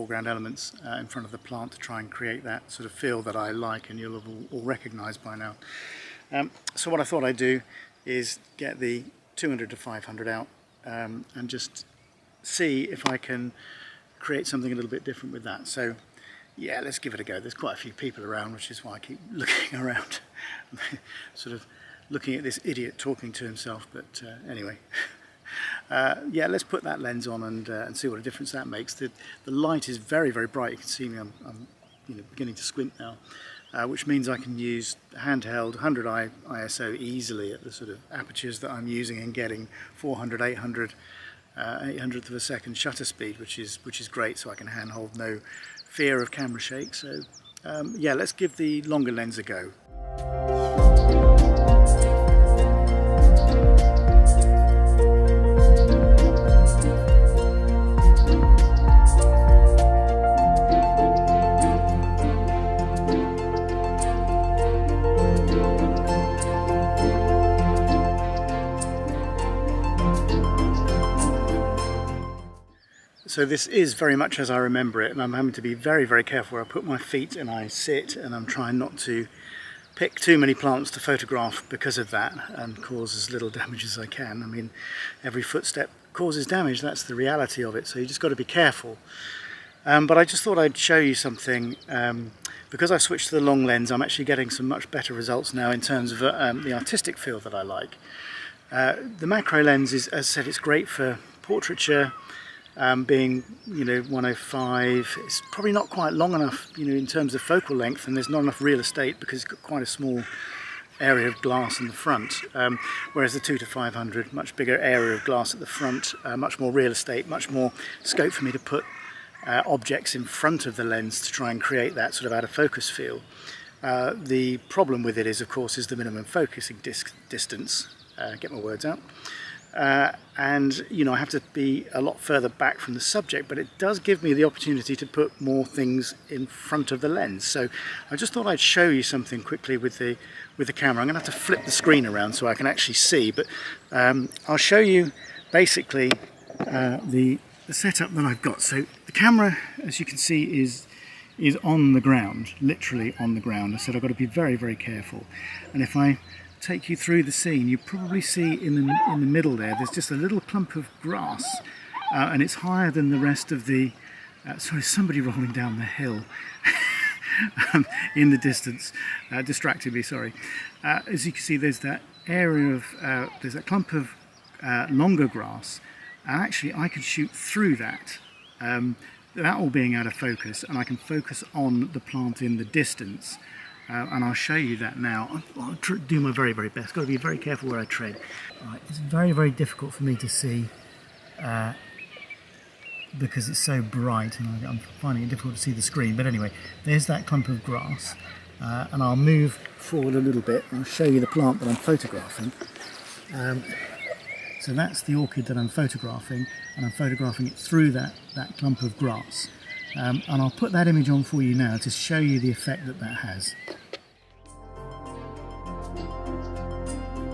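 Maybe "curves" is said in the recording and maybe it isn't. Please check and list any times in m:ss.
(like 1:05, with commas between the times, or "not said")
not said.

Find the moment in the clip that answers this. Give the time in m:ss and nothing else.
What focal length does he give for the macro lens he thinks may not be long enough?
1:44.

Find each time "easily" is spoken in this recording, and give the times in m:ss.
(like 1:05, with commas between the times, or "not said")
0:36.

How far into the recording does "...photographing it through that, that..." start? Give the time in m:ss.
3:26.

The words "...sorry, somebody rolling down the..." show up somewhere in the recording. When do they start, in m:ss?
2:44.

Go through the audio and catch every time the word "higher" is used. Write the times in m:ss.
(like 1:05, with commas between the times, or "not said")
2:42.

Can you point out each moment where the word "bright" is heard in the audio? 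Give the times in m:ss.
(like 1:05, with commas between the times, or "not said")
0:30, 3:13.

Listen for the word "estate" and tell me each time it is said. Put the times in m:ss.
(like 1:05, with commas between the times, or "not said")
1:48, 1:56.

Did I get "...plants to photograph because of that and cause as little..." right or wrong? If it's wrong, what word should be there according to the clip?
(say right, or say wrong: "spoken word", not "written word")
right.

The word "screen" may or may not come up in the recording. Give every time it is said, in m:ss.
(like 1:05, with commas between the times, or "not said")
2:21, 3:15.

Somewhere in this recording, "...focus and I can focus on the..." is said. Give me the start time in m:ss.
3:00.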